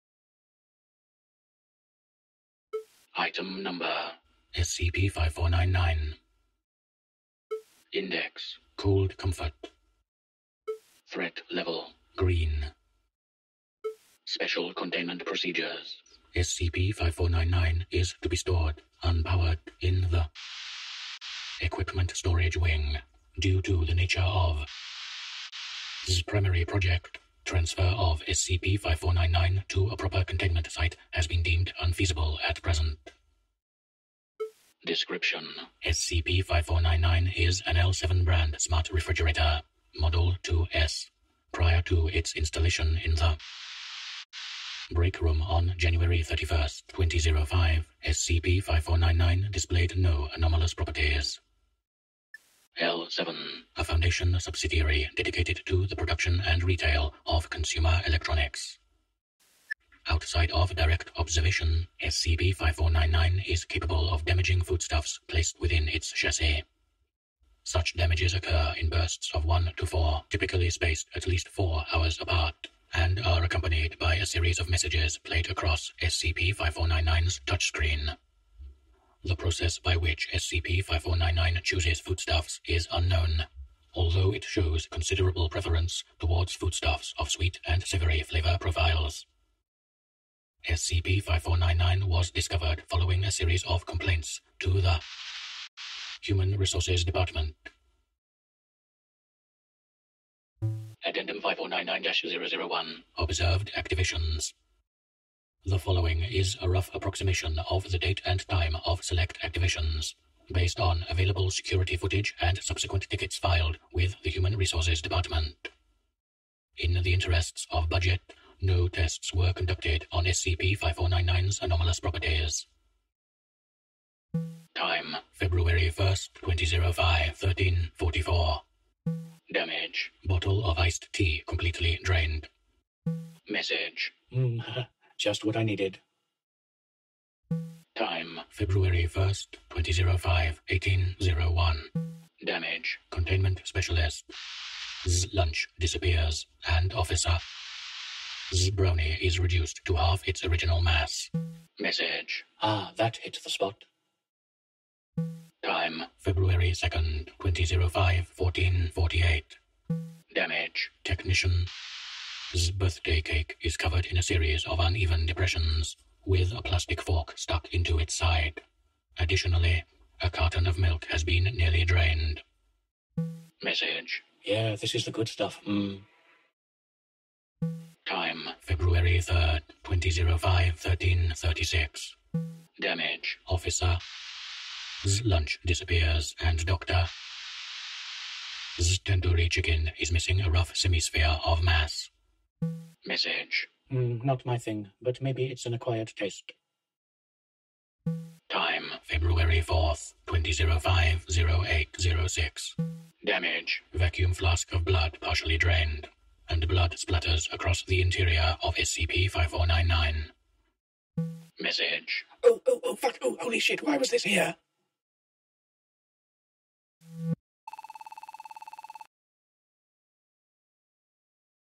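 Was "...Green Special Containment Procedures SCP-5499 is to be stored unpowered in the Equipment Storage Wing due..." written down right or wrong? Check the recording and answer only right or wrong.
right.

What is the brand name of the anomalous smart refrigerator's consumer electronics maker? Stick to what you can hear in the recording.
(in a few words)
L7.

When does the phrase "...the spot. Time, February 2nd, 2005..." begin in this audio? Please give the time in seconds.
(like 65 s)
153 s.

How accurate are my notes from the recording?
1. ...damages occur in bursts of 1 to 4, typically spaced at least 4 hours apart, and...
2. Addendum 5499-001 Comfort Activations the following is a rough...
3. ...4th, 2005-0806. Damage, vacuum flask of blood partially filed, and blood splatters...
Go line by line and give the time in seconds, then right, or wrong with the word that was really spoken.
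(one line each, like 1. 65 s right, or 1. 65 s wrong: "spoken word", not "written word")
1. 67 s right
2. 101 s wrong: "Observed", not "Comfort"
3. 199 s wrong: "drained", not "filed".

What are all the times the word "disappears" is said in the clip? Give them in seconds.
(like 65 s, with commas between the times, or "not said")
145 s, 185 s.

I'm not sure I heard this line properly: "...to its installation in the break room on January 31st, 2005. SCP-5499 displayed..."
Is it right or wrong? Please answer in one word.
right.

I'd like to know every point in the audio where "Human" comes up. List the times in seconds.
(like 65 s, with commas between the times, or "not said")
96 s, 114 s.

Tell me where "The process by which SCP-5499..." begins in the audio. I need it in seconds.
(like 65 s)
79 s.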